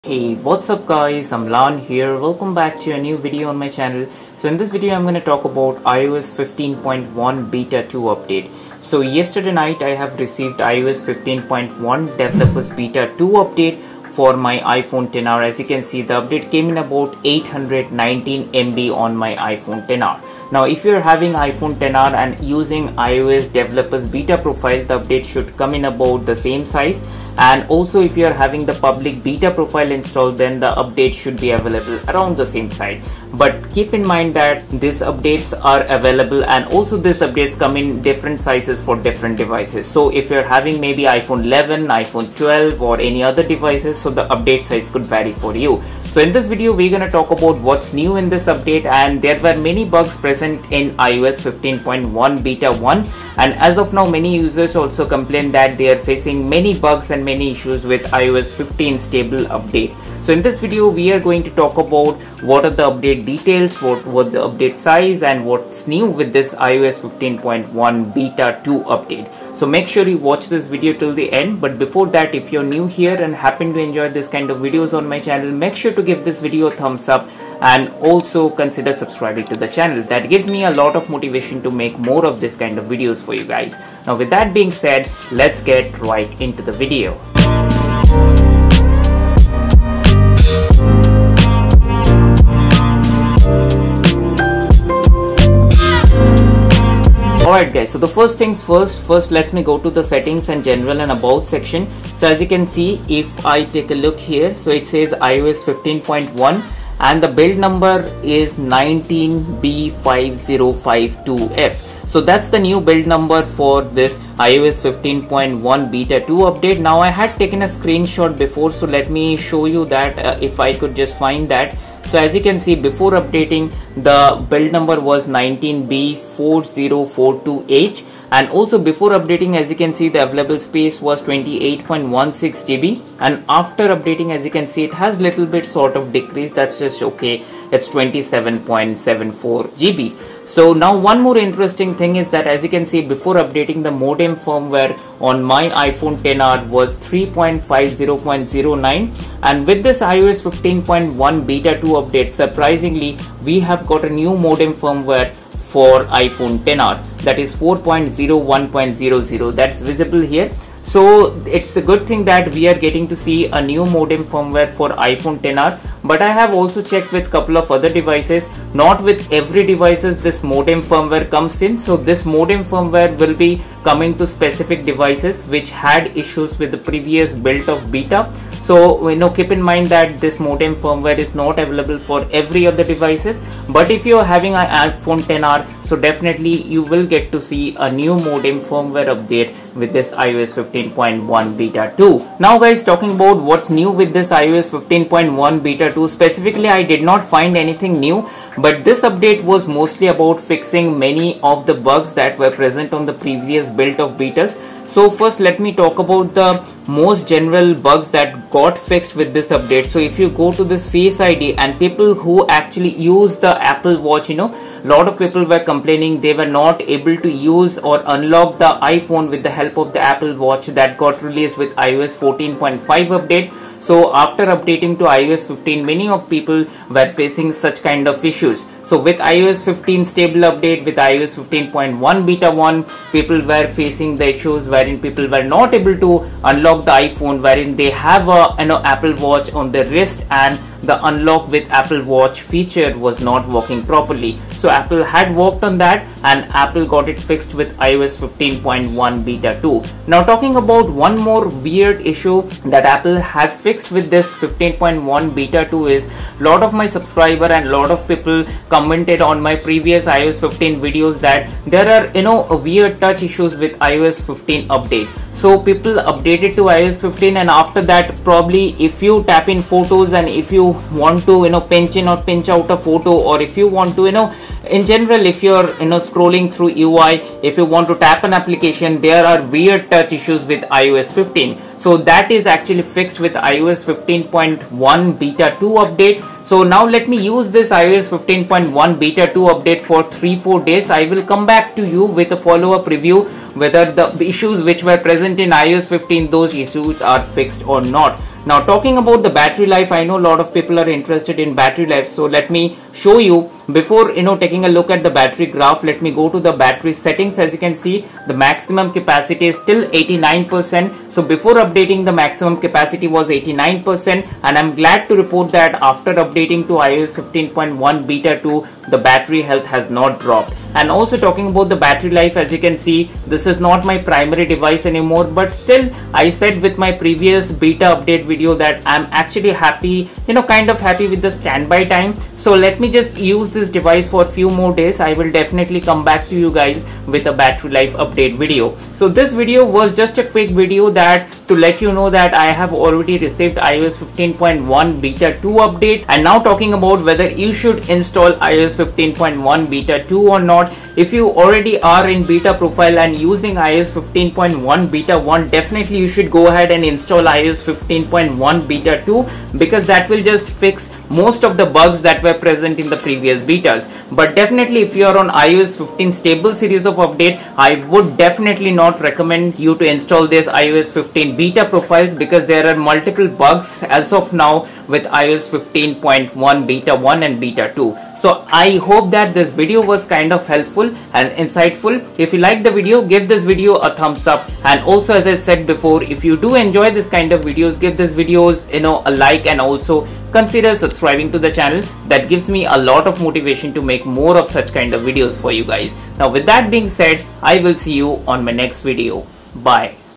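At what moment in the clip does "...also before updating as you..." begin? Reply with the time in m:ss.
2:08.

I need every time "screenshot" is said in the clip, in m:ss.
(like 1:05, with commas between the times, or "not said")
1:57.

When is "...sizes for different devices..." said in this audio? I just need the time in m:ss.
0:38.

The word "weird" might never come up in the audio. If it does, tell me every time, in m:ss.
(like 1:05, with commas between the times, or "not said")
4:11, 4:22, 4:39.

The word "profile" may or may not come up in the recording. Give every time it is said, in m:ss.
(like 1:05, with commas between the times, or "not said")
0:24, 0:29, 5:52, 6:11.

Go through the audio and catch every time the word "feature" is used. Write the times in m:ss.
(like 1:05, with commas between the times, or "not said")
4:02.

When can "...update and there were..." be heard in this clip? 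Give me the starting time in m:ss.
0:48.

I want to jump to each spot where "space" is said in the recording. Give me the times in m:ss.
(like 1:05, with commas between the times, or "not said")
2:10.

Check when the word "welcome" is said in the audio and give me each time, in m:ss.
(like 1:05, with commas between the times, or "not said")
0:02.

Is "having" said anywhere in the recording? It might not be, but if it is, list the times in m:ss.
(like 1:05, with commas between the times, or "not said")
0:21, 0:28, 0:40, 3:04.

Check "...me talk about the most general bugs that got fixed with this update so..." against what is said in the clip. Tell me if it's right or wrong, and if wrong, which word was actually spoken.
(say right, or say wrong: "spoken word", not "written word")
right.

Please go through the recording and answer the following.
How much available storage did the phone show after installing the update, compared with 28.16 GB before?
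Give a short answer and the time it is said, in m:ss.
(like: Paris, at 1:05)
27.74 GB, at 2:17.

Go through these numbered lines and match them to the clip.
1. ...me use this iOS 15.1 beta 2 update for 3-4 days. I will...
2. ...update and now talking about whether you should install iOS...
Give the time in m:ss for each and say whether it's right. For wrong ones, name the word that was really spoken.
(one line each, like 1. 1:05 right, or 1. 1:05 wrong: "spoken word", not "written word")
1. 4:47 right
2. 5:45 right.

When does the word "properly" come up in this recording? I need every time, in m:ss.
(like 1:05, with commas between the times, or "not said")
4:03.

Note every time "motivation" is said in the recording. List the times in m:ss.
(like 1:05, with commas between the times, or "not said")
1:21, 6:33.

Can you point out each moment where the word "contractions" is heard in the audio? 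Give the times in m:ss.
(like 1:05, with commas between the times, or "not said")
not said.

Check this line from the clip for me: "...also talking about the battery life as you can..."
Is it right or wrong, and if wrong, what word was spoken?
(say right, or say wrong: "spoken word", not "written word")
right.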